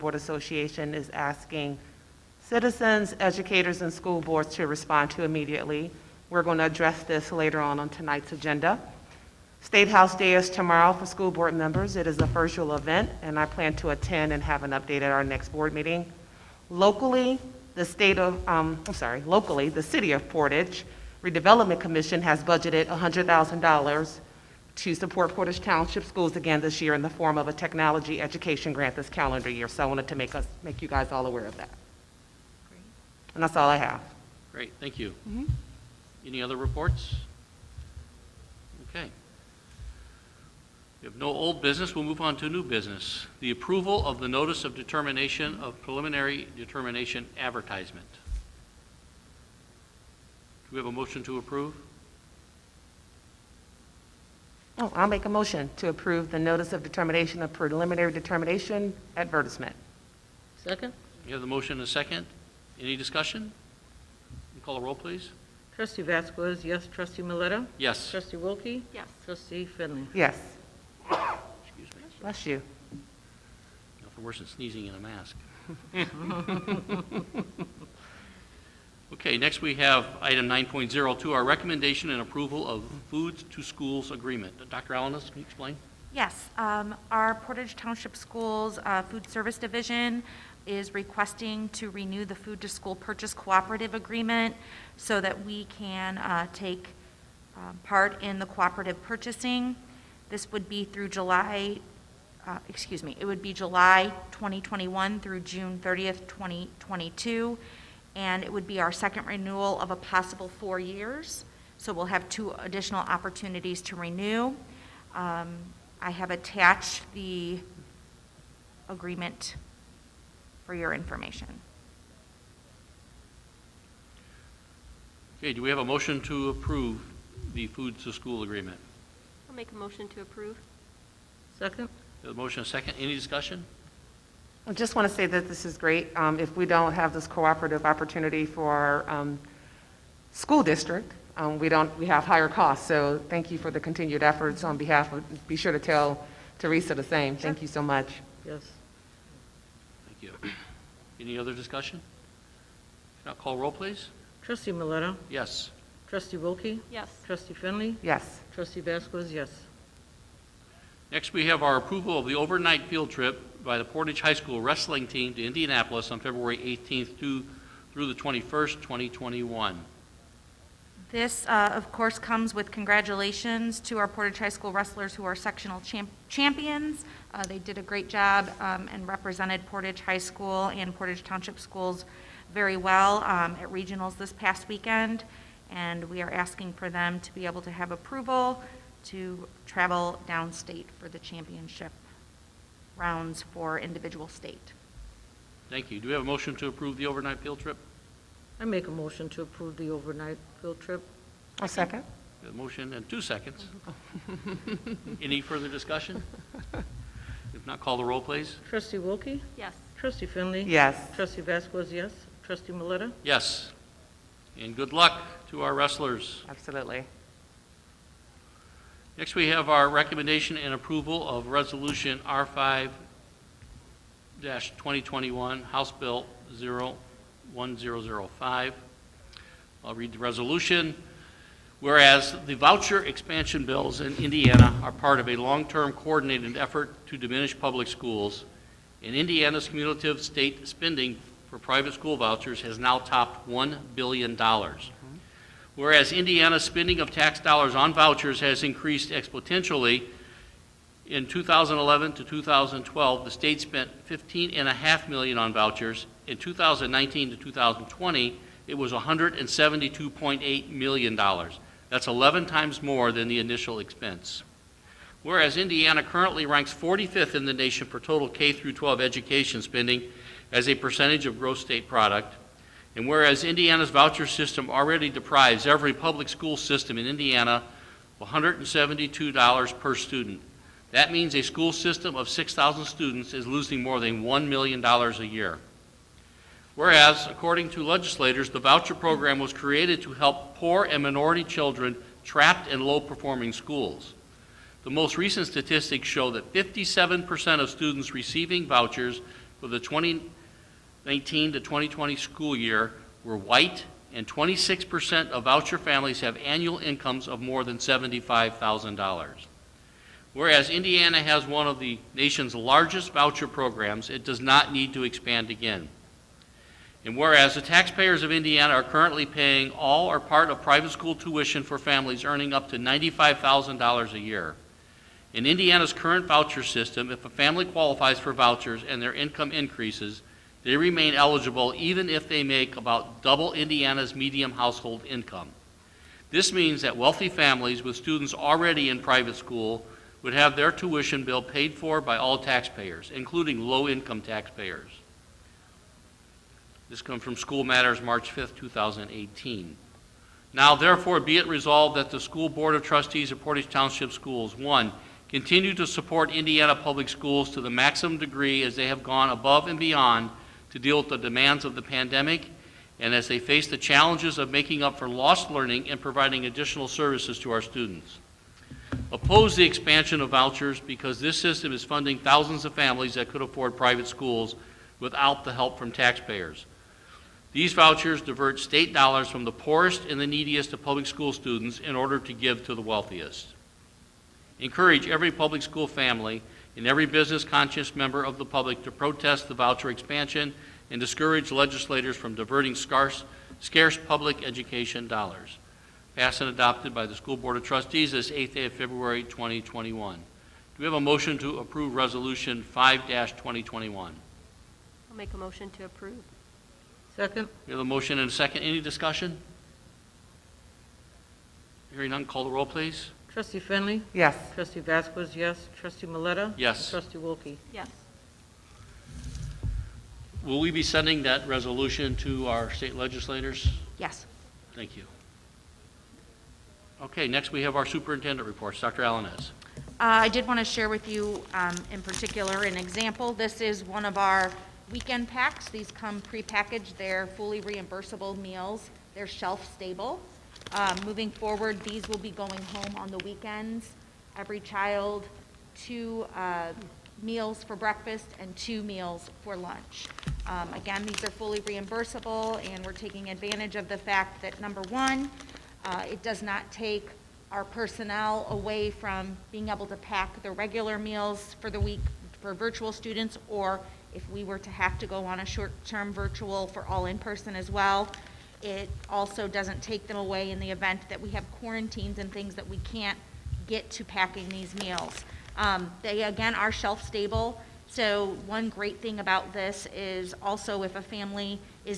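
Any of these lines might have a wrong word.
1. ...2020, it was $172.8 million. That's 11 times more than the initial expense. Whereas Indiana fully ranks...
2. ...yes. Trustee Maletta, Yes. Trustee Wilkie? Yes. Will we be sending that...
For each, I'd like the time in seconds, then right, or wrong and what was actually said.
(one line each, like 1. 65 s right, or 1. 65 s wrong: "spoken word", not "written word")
1. 257 s wrong: "currently", not "fully"
2. 415 s right.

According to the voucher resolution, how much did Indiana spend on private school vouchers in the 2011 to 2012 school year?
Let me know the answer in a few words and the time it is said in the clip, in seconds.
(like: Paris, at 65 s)
$15.5 million, at 254 s.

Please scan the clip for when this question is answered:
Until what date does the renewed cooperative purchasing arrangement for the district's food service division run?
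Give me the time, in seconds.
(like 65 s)
105 s.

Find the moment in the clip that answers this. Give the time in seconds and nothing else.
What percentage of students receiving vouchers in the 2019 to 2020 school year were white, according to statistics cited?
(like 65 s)
296 s.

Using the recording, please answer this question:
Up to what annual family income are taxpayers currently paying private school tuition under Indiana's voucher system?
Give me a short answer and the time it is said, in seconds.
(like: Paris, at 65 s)
$95,000, at 322 s.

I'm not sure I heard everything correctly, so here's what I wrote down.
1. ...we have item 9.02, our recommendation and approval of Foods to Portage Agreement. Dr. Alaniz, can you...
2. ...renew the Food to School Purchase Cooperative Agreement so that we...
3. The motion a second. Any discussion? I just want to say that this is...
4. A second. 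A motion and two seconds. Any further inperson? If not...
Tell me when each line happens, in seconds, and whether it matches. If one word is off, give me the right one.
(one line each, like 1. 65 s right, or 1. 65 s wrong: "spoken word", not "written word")
1. 79 s wrong: "Schools", not "Portage"
2. 91 s right
3. 132 s right
4. 201 s wrong: "discussion", not "inperson".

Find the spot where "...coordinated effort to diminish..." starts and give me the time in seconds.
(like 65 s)
235 s.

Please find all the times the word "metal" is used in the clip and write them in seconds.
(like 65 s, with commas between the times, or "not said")
not said.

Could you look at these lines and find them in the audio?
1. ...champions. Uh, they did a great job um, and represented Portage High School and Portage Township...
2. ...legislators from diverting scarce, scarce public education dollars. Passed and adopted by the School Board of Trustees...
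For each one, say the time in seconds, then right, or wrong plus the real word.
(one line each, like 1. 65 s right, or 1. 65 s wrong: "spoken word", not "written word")
1. 176 s right
2. 391 s right.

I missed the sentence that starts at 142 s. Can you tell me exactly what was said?
So thank you for the continued efforts on behalf of.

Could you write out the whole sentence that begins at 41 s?
We'll move on to new business.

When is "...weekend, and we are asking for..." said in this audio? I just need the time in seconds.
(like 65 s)
184 s.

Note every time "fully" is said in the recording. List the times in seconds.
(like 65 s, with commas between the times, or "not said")
437 s, 451 s.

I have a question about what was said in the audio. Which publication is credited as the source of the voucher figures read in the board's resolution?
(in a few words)
School Matters.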